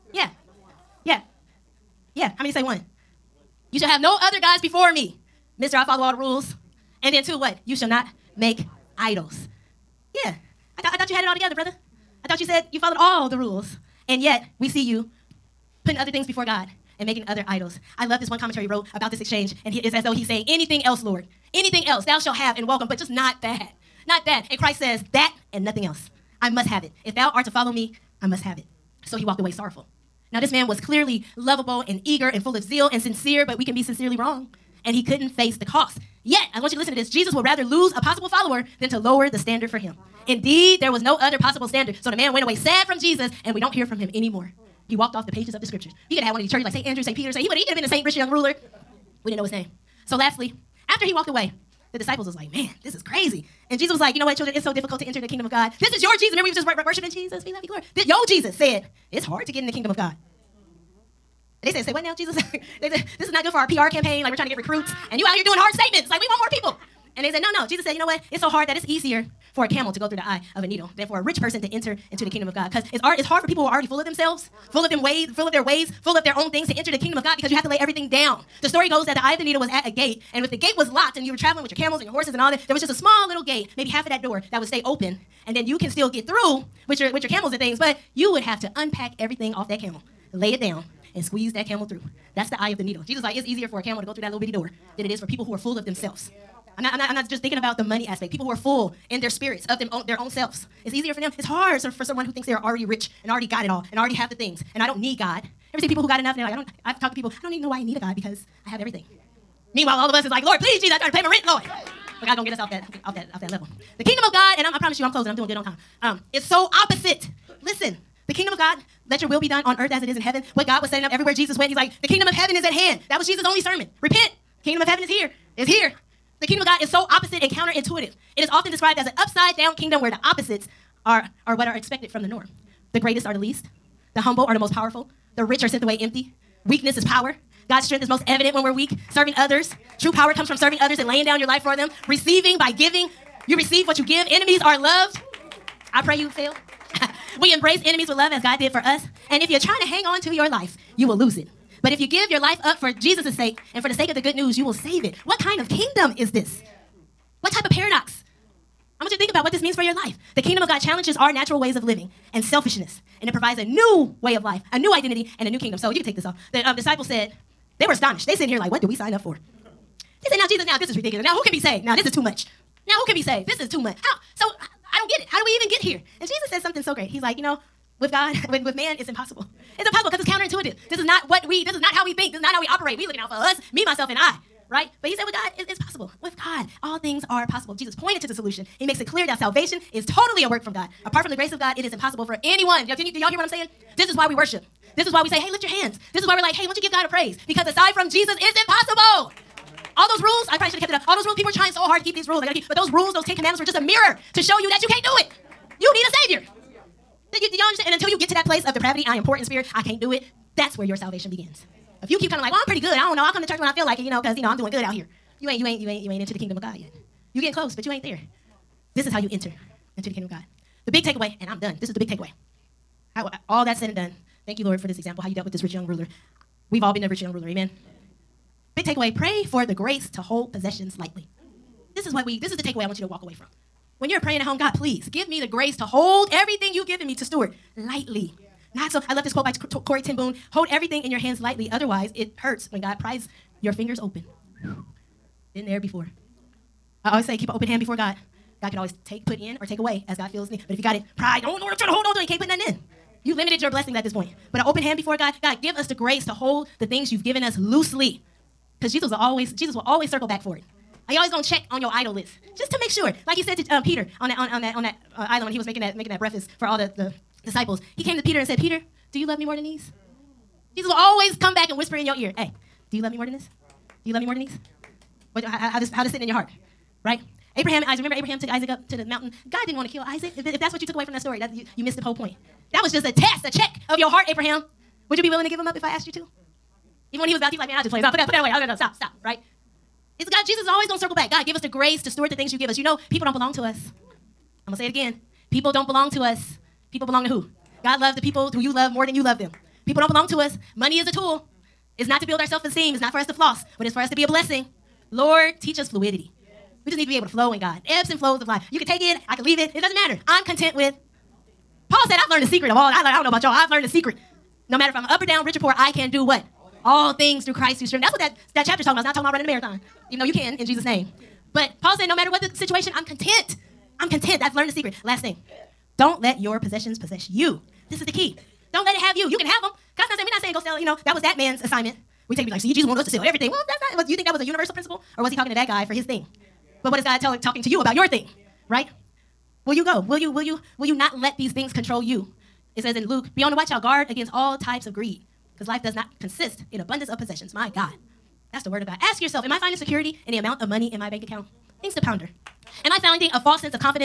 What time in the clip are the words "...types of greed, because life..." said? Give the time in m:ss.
5:44.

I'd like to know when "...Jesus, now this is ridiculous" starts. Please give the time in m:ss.
2:50.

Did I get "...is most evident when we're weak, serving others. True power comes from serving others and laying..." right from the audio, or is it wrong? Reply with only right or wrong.
right.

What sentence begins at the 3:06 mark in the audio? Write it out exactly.
With God, all things are possible.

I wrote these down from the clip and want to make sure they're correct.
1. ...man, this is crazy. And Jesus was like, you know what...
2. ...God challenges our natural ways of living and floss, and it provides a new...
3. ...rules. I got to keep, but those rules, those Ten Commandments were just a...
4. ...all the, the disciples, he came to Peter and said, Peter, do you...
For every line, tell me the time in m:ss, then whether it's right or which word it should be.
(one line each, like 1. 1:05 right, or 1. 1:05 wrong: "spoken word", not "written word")
1. 0:52 right
2. 2:40 wrong: "selfishness", not "floss"
3. 3:22 right
4. 4:26 right.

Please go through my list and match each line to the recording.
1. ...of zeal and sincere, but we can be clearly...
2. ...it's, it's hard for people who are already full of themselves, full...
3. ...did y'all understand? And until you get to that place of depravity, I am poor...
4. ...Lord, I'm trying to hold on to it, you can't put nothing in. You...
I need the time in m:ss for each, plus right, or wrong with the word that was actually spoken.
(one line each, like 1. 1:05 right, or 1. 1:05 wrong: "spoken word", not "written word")
1. 0:32 wrong: "sincerely", not "clearly"
2. 1:12 right
3. 3:27 right
4. 4:11 right.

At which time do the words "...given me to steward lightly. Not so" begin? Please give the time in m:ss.
3:56.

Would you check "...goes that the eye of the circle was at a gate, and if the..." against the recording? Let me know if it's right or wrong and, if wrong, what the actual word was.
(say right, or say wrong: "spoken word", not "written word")
wrong: "needle", not "circle".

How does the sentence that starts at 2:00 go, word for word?
What God was setting up everywhere Jesus went, he's like, the kingdom of heaven is at hand.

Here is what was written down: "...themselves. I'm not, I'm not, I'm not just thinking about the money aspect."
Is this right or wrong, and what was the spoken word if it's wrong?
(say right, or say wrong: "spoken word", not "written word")
right.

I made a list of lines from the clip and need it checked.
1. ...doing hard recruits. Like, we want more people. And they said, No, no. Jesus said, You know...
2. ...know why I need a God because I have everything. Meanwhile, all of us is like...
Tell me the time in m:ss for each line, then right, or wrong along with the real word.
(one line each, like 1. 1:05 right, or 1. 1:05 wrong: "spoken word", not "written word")
1. 1:05 wrong: "statements", not "recruits"
2. 1:47 right.